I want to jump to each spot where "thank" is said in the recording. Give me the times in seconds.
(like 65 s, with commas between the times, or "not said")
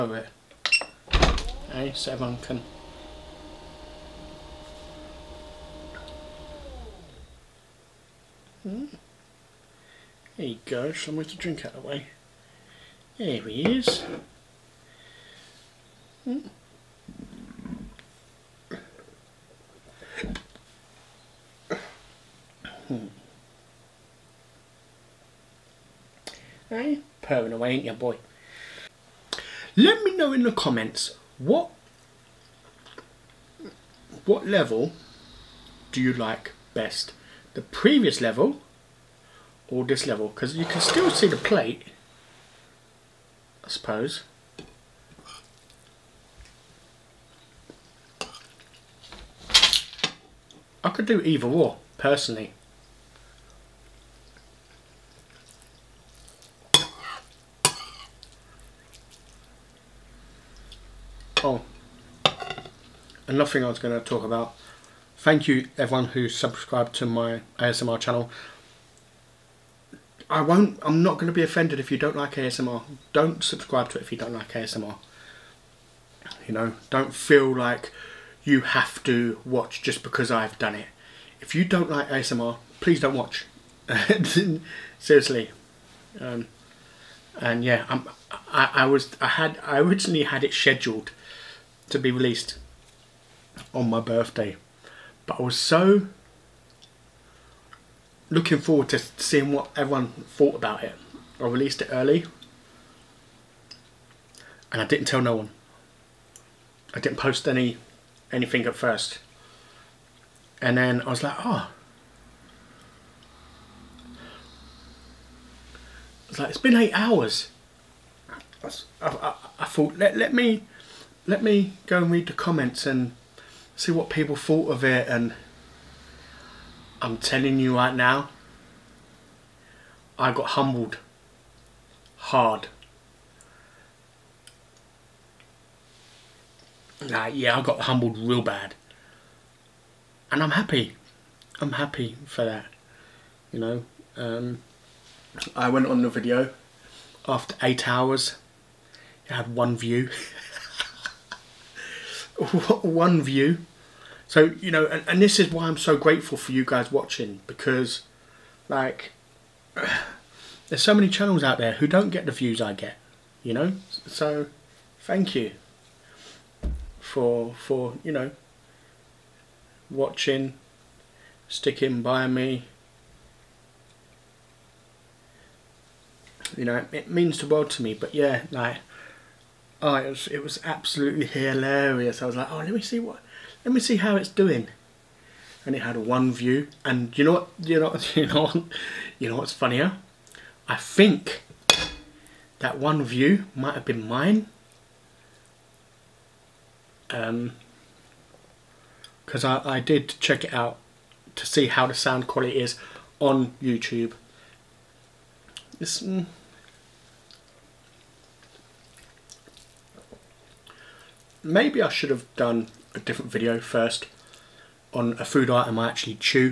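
65 s, 165 s.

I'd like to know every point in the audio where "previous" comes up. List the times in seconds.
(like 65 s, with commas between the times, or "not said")
37 s.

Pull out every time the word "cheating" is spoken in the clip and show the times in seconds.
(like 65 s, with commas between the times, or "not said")
not said.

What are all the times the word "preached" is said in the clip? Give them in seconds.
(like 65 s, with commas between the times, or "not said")
not said.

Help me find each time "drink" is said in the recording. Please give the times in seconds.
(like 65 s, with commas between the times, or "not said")
11 s.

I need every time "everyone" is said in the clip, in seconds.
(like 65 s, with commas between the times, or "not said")
2 s, 65 s, 99 s.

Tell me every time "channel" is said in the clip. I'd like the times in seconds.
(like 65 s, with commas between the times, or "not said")
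67 s, 161 s.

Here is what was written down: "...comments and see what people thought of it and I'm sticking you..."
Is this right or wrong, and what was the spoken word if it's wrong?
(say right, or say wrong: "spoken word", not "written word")
wrong: "telling", not "sticking".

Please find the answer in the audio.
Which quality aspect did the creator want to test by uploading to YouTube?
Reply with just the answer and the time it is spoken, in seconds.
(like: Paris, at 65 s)
Sound quality, at 201 s.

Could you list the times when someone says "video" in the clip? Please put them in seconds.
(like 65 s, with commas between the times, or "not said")
146 s, 213 s.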